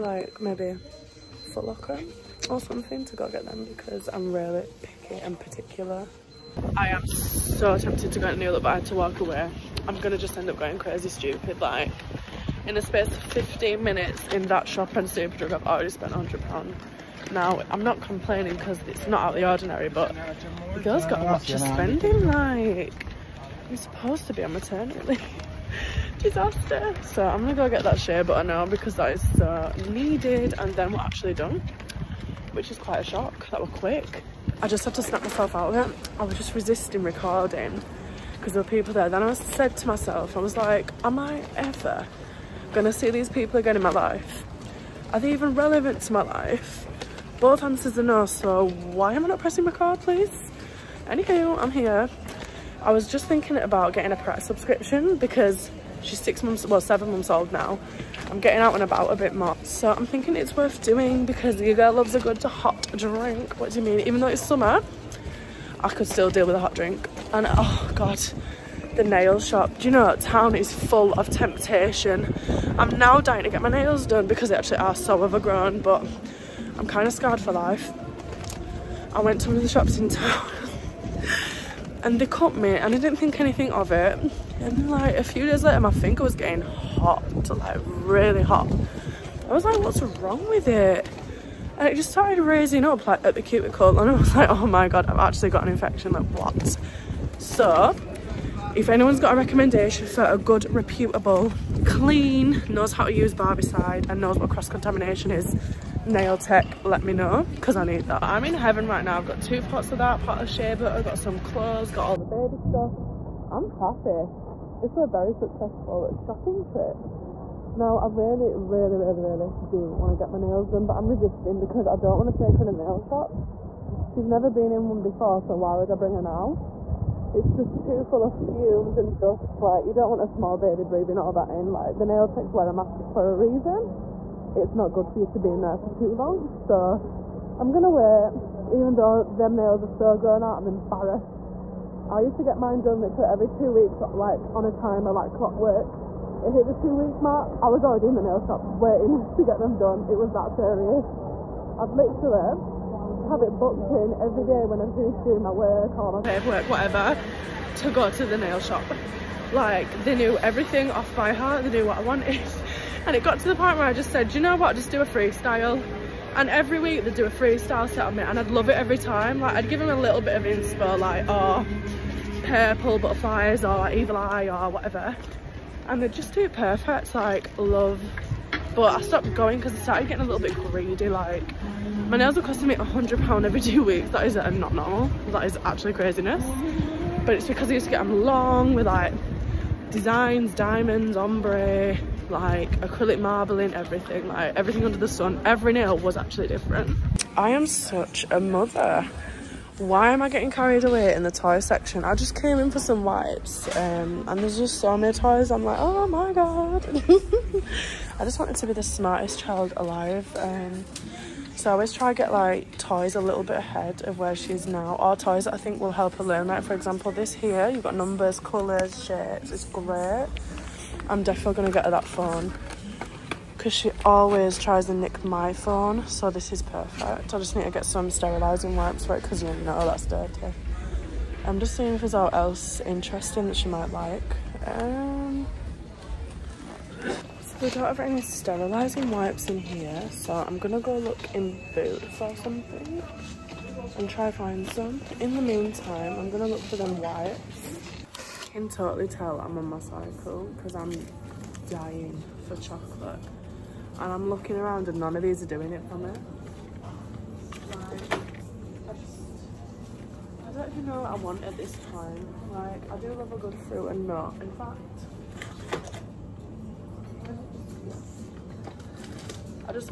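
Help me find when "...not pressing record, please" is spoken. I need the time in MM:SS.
00:49.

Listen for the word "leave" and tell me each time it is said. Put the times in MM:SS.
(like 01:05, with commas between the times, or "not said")
00:25.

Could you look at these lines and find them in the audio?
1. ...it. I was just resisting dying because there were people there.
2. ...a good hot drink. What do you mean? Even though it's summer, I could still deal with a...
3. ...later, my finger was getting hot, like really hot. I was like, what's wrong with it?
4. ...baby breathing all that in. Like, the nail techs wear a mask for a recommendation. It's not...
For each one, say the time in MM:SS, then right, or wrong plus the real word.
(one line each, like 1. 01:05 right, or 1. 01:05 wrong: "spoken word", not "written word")
1. 00:35 wrong: "recording", not "dying"
2. 01:02 right
3. 01:25 right
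4. 02:10 wrong: "reason", not "recommendation".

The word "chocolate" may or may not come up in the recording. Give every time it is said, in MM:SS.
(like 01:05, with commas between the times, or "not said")
04:12.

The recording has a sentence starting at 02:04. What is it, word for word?
She's never been in one before, so why would I bring her now?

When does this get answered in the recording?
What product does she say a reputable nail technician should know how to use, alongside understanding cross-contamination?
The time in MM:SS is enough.
01:43.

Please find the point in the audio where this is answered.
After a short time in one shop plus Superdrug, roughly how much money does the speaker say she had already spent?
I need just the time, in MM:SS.
00:16.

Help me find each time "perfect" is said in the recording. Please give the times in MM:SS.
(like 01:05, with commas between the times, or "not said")
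02:56, 03:46.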